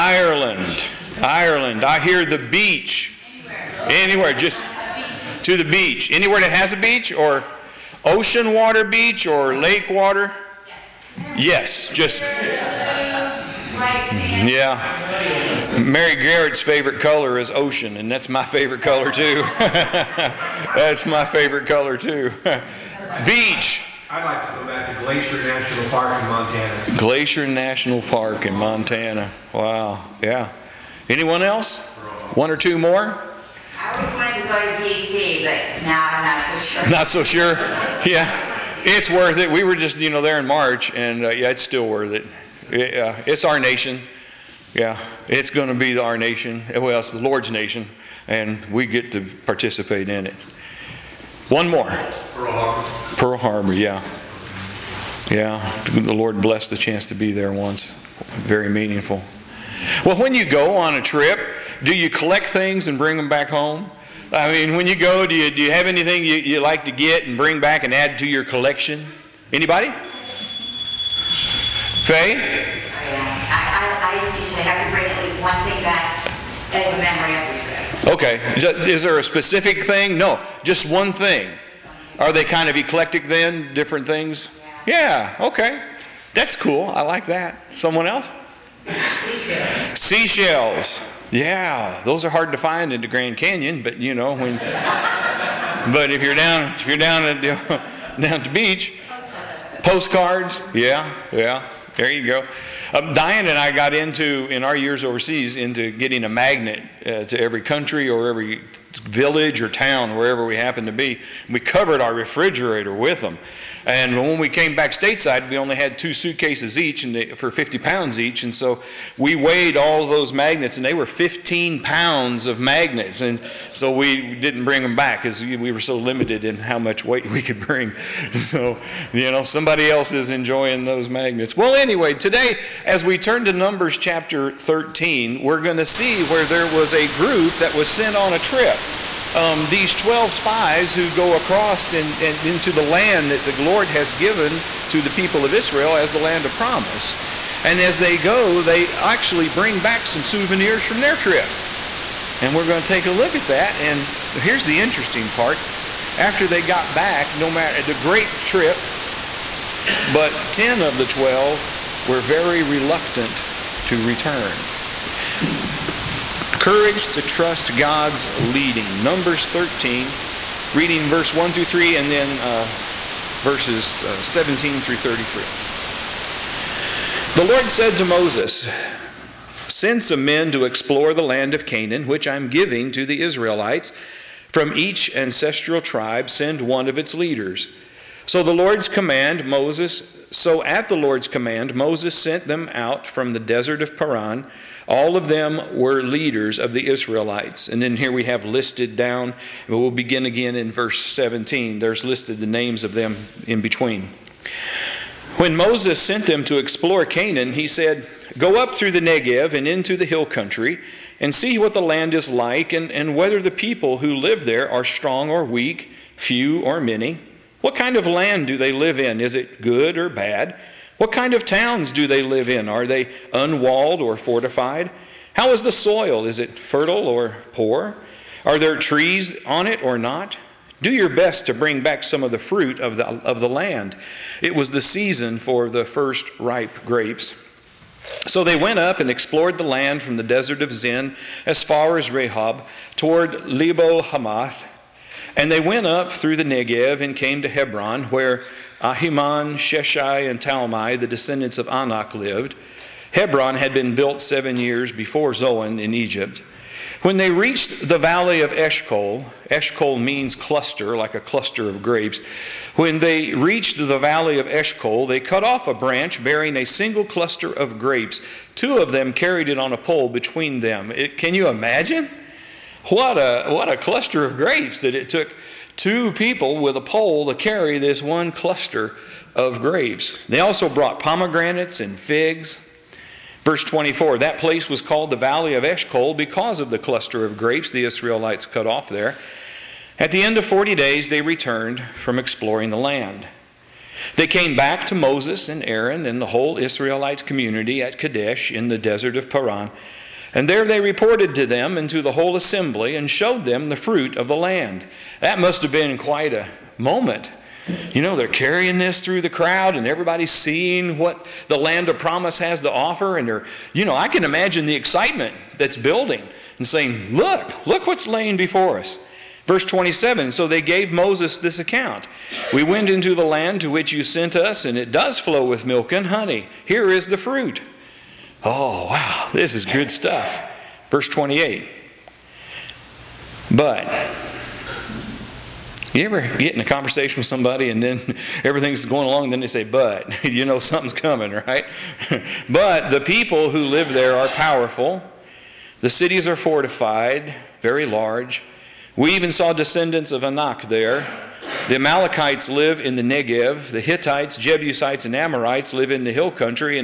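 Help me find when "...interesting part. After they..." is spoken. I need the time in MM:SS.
02:34.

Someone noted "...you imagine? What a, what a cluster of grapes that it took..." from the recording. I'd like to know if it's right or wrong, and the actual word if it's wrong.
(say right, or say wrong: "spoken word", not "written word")
right.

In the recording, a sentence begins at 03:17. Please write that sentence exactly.
And then here we have listed down, we'll begin again in verse 17.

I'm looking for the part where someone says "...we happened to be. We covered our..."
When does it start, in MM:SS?
01:50.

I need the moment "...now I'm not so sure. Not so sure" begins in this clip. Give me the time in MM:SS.
00:35.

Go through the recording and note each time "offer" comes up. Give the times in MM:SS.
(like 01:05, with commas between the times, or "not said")
05:12.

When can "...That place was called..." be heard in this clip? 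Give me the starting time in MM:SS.
04:44.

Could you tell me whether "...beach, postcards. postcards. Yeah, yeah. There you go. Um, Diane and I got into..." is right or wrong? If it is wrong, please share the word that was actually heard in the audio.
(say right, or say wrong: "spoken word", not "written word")
right.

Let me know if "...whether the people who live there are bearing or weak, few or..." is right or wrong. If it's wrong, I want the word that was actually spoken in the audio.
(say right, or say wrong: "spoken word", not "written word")
wrong: "strong", not "bearing".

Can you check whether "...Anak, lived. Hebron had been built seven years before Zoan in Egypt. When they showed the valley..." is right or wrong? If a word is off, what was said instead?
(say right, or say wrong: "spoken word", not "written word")
wrong: "reached", not "showed".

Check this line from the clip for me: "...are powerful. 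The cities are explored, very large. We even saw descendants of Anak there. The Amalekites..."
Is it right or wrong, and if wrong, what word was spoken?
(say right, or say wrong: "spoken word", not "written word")
wrong: "fortified", not "explored".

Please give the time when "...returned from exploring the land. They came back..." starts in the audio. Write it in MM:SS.
04:51.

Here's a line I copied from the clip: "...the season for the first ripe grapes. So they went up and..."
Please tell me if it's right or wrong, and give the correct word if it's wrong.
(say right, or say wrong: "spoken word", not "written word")
right.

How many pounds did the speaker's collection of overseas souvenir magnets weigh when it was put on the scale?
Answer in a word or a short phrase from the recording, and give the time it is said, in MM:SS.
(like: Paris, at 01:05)
15 pounds, at 02:01.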